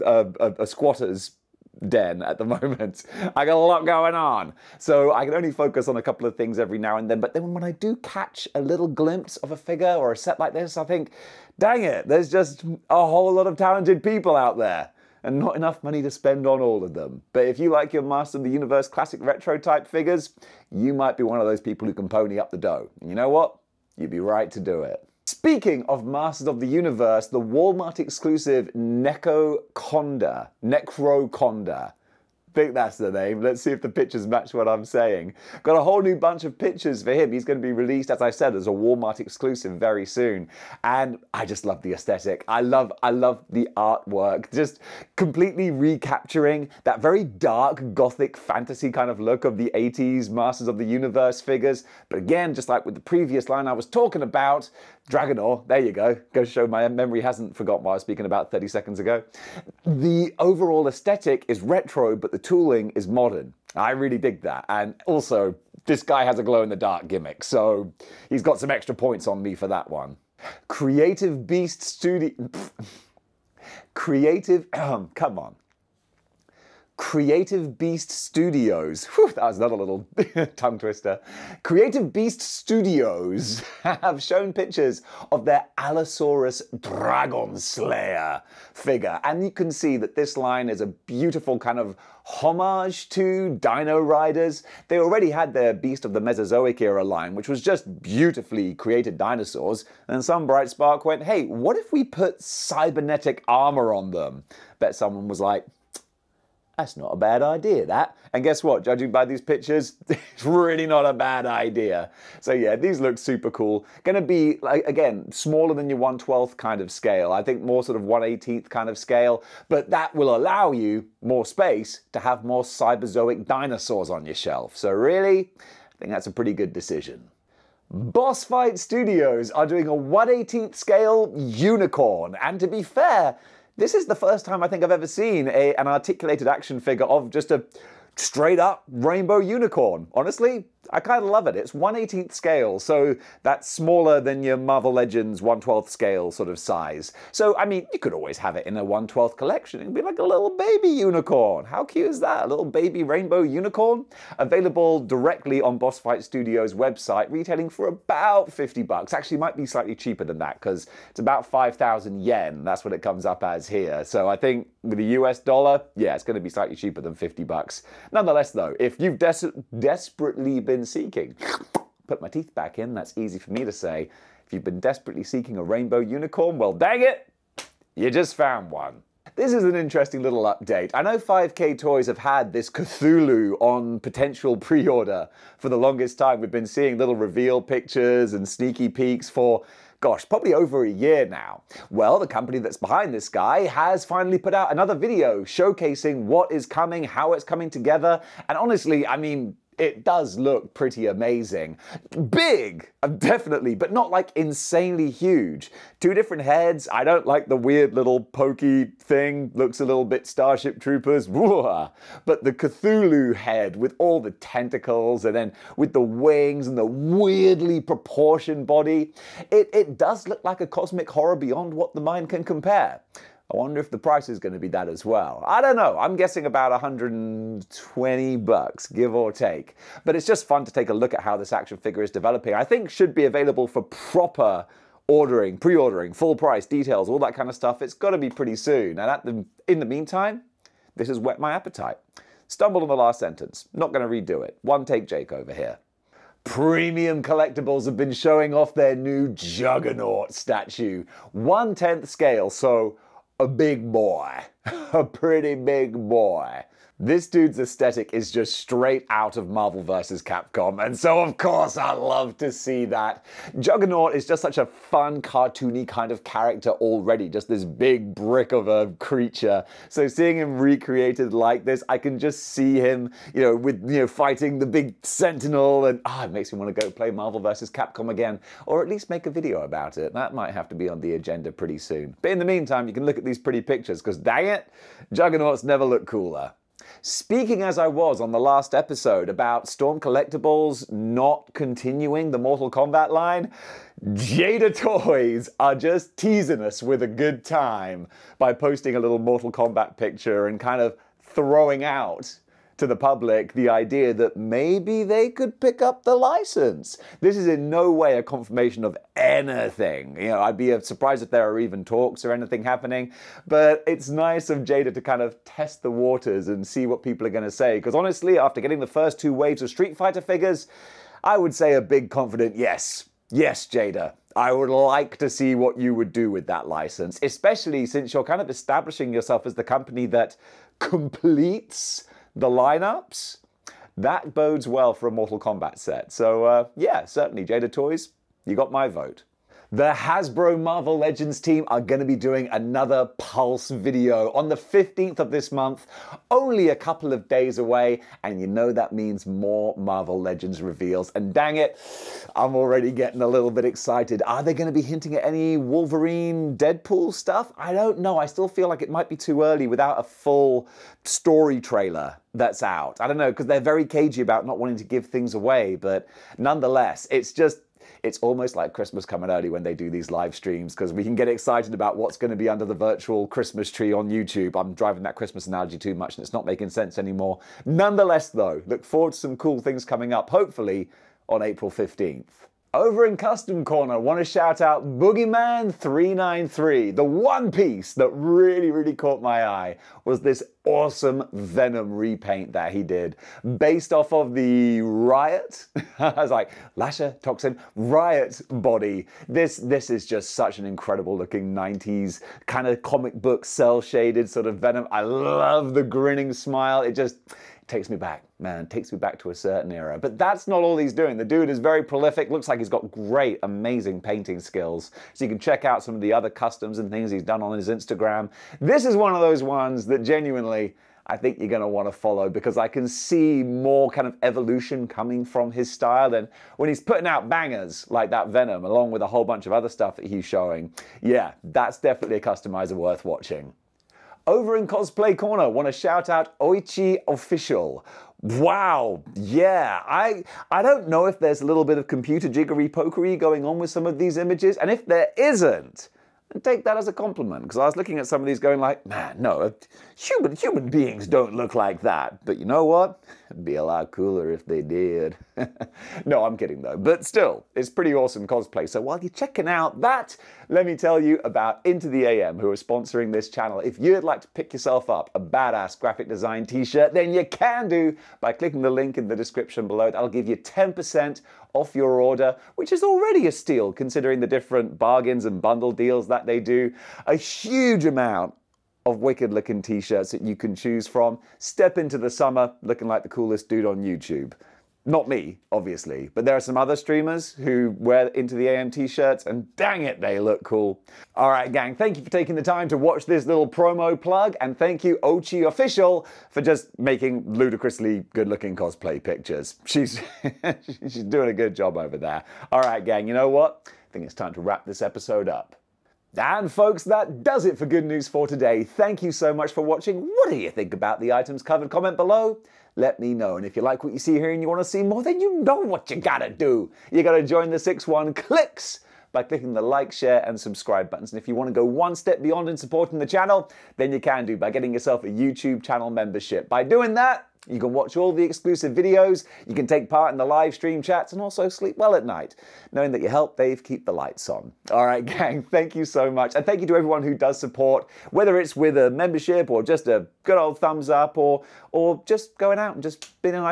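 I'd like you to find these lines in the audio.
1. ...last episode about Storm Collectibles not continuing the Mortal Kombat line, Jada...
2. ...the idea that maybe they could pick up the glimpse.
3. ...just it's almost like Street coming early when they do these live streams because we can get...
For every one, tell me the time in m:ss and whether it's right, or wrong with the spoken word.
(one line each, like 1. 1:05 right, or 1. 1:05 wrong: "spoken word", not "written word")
1. 4:48 right
2. 5:03 wrong: "license", not "glimpse"
3. 6:07 wrong: "Christmas", not "Street".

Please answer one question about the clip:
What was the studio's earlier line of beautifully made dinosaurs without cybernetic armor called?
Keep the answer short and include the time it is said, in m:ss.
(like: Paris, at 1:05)
Beast of the Mesozoic, at 1:35.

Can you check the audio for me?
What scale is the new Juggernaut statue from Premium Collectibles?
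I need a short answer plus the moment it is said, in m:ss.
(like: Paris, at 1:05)
1/10 scale, at 4:11.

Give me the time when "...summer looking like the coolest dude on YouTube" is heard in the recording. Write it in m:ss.
8:02.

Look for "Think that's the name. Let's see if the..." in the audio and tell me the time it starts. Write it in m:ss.
0:32.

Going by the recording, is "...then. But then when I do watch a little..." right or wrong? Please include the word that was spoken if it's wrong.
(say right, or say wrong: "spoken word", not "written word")
wrong: "catch", not "watch".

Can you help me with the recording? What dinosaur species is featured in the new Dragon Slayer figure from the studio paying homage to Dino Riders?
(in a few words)
Allosaurus.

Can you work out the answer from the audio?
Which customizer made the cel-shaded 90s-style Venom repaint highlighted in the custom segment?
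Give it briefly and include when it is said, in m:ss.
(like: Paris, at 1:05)
Boogeyman393, at 6:24.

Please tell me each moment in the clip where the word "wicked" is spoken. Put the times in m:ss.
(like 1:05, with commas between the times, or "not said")
7:58.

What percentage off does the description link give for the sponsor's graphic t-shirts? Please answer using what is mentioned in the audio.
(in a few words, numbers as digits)
10%.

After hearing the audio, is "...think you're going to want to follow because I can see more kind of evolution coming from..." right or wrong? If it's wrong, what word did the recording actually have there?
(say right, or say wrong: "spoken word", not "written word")
right.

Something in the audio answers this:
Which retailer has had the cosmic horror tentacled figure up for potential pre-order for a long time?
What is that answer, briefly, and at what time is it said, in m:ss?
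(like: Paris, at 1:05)
5K Toys, at 3:01.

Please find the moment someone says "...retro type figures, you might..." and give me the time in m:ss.
0:19.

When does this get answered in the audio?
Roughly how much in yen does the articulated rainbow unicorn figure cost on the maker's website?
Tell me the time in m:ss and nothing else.
2:41.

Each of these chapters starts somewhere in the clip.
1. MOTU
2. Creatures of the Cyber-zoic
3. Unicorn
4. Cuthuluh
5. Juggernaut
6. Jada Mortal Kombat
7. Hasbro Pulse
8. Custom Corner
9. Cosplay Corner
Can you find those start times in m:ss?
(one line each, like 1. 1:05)
1. 0:22
2. 1:09
3. 2:06
4. 2:58
5. 4:05
6. 4:45
7. 5:38
8. 6:21
9. 7:12.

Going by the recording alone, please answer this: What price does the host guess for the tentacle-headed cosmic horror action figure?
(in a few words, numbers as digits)
$120.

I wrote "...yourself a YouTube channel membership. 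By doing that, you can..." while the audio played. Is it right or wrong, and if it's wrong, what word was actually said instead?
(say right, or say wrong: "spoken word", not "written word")
right.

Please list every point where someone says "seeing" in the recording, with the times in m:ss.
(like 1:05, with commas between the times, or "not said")
3:06, 4:30.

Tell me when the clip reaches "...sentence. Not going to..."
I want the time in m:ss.
4:03.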